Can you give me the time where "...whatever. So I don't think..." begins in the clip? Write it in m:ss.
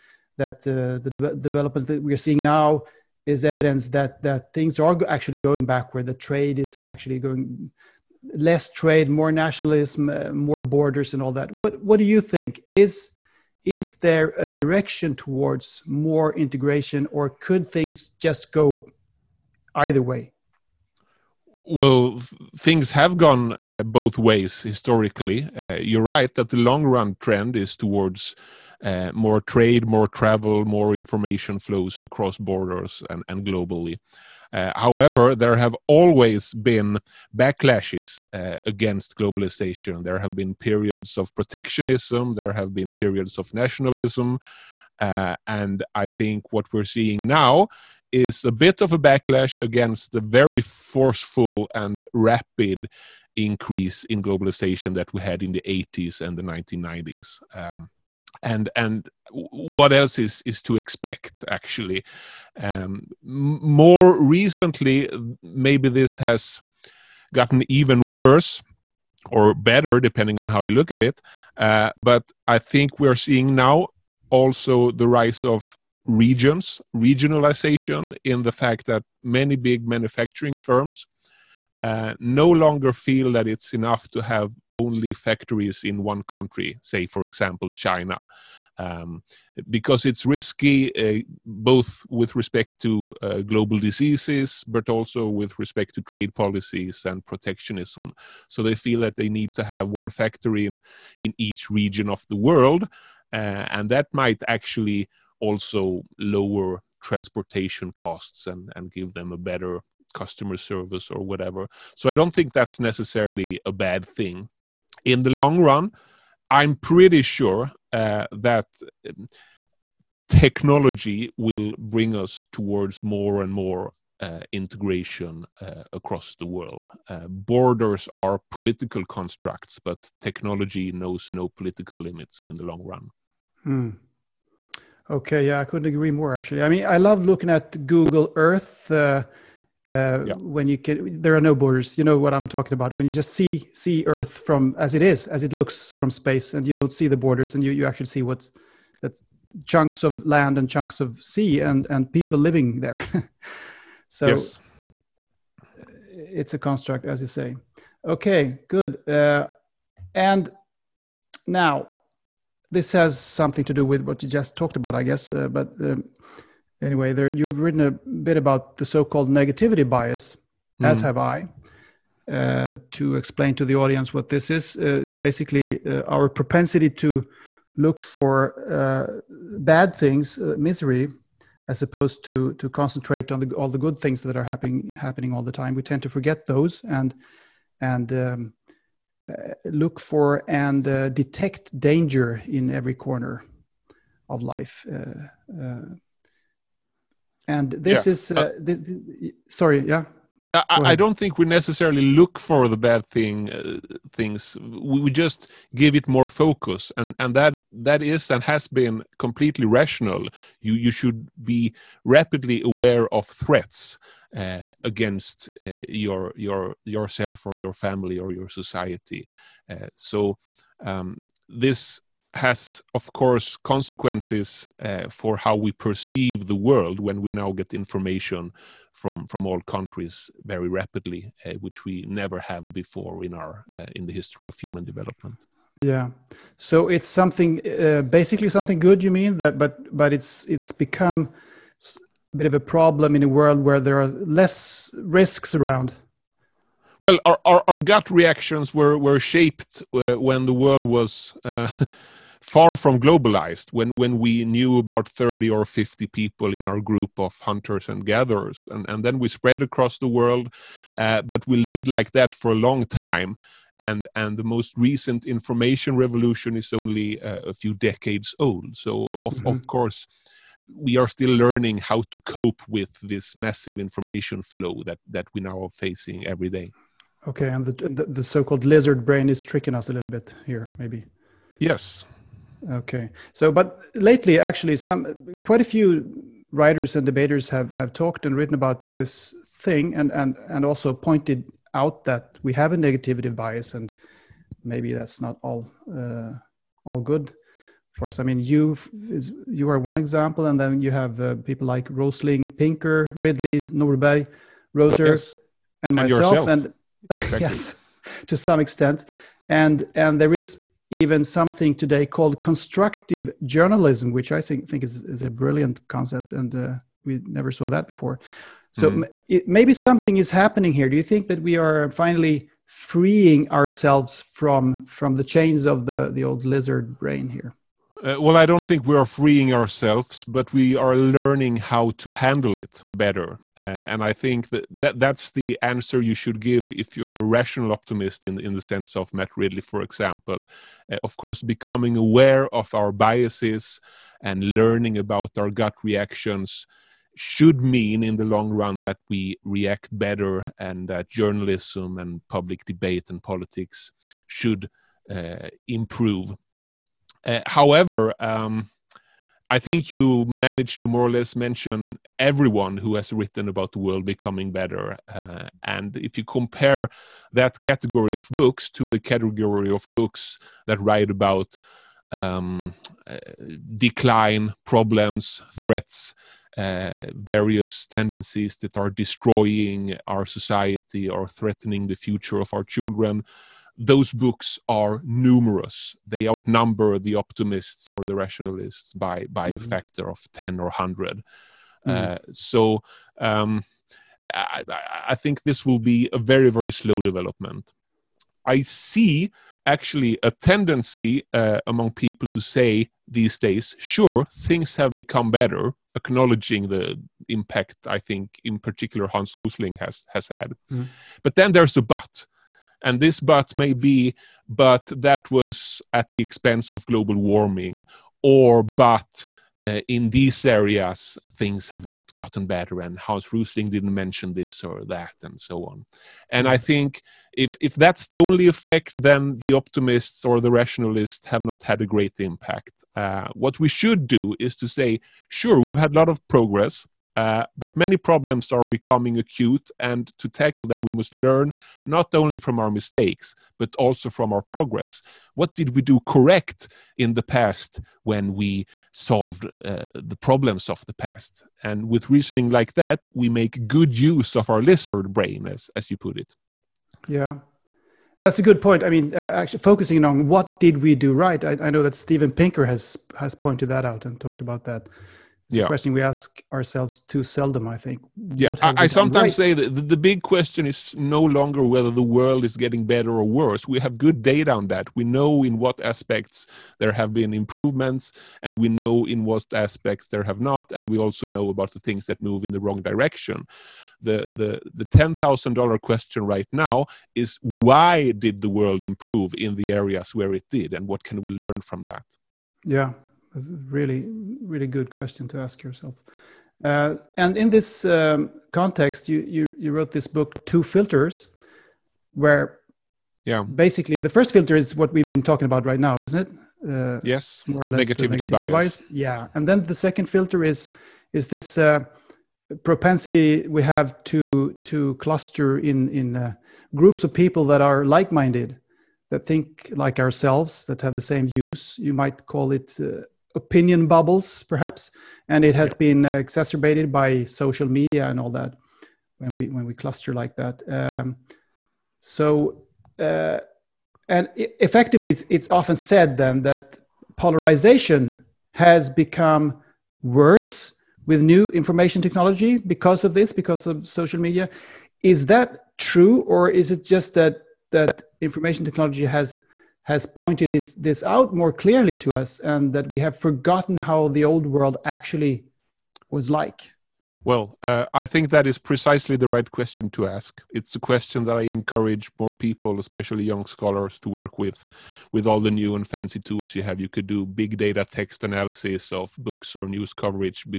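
1:51.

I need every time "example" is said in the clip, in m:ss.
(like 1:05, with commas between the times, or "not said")
1:27, 4:59, 5:39.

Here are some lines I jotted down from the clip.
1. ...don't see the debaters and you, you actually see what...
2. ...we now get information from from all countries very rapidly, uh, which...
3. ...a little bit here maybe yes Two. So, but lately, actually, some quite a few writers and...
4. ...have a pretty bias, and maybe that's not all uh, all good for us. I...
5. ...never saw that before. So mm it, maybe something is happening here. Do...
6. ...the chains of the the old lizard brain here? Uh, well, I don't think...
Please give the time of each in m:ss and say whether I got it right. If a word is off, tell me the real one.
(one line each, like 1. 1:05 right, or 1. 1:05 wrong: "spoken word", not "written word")
1. 2:26 wrong: "borders", not "debaters"
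2. 3:47 right
3. 4:39 wrong: "Okay", not "Two"
4. 4:52 wrong: "negativity", not "pretty"
5. 5:17 right
6. 5:25 right.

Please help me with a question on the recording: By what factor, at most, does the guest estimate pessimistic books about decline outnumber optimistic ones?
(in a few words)
100.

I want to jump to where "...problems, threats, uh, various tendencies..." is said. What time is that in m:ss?
6:14.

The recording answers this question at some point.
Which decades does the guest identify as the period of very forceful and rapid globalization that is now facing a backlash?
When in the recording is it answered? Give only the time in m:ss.
0:55.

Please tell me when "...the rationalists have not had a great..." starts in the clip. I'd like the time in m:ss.
7:10.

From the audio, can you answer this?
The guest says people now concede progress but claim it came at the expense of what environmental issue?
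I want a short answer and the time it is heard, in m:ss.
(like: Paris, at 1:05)
Global warming, at 6:56.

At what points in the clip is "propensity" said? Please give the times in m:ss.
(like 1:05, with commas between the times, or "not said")
2:56, 8:32.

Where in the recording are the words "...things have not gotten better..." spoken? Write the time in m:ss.
7:01.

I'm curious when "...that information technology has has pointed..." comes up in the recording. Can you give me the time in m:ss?
9:07.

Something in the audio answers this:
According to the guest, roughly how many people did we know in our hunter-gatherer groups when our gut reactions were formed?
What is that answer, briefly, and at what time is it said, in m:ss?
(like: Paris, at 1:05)
30 or 50, at 4:15.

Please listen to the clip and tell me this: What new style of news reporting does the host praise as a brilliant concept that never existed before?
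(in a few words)
Constructive journalism.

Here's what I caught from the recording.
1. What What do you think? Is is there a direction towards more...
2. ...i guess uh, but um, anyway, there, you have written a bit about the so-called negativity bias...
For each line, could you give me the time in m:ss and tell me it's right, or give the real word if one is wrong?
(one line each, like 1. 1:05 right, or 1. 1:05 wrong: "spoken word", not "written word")
1. 0:11 right
2. 2:44 right.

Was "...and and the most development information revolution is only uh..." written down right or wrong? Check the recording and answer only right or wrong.
wrong.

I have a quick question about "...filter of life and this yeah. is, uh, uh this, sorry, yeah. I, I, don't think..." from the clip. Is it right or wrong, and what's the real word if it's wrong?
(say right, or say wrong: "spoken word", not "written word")
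wrong: "corner", not "filter".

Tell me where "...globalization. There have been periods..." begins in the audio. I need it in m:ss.
0:39.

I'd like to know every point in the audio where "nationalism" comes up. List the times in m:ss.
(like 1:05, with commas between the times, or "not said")
0:09, 0:43.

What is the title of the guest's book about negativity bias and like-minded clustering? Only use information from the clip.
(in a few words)
Two Filters.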